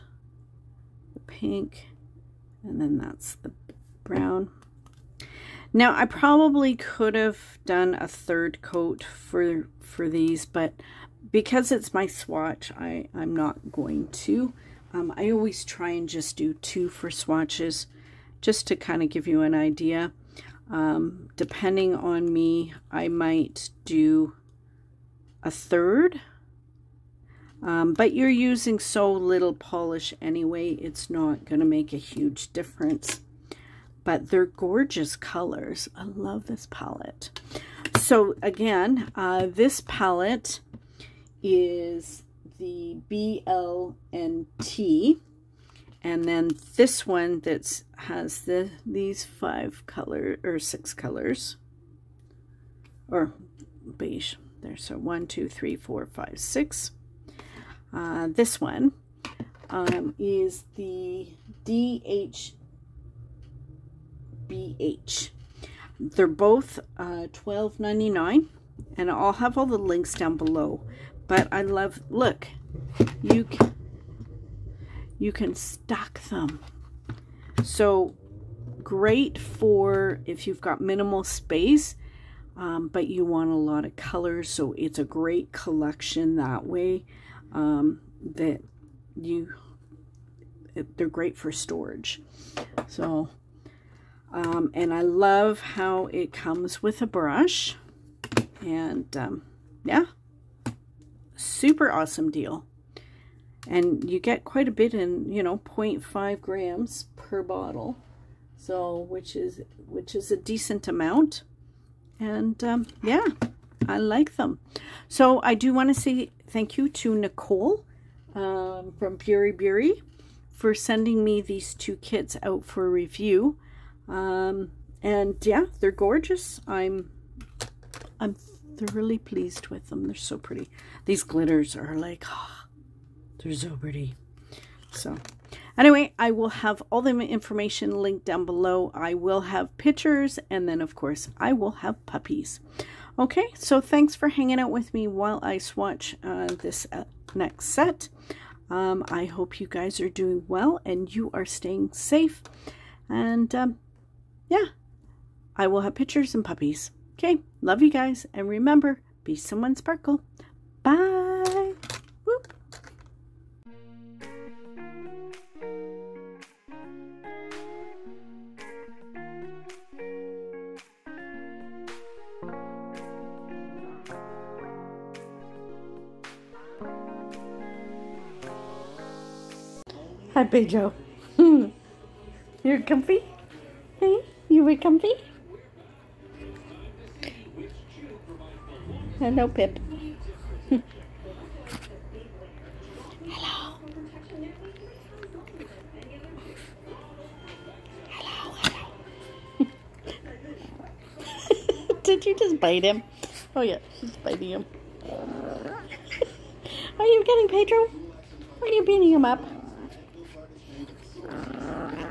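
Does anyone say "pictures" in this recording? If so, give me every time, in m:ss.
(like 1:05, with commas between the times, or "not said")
2:19, 2:35.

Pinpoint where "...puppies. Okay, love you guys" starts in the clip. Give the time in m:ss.
2:36.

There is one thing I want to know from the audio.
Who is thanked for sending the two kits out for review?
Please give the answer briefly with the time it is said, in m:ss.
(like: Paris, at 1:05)
Nicole, at 1:57.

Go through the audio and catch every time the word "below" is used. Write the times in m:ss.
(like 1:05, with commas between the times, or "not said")
1:10, 2:18.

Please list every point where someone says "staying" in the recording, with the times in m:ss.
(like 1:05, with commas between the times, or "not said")
2:31.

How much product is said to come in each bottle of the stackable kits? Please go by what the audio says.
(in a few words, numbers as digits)
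0.5 grams.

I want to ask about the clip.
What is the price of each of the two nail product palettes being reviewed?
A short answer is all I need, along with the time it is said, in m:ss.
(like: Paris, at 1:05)
$12.99, at 1:07.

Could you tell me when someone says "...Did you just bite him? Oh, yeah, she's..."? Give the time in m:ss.
3:22.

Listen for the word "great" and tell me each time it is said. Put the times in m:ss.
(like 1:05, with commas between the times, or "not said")
1:18, 1:25, 1:31.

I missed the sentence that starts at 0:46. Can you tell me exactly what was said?
And then this one that has the these five color or six colors or beige there.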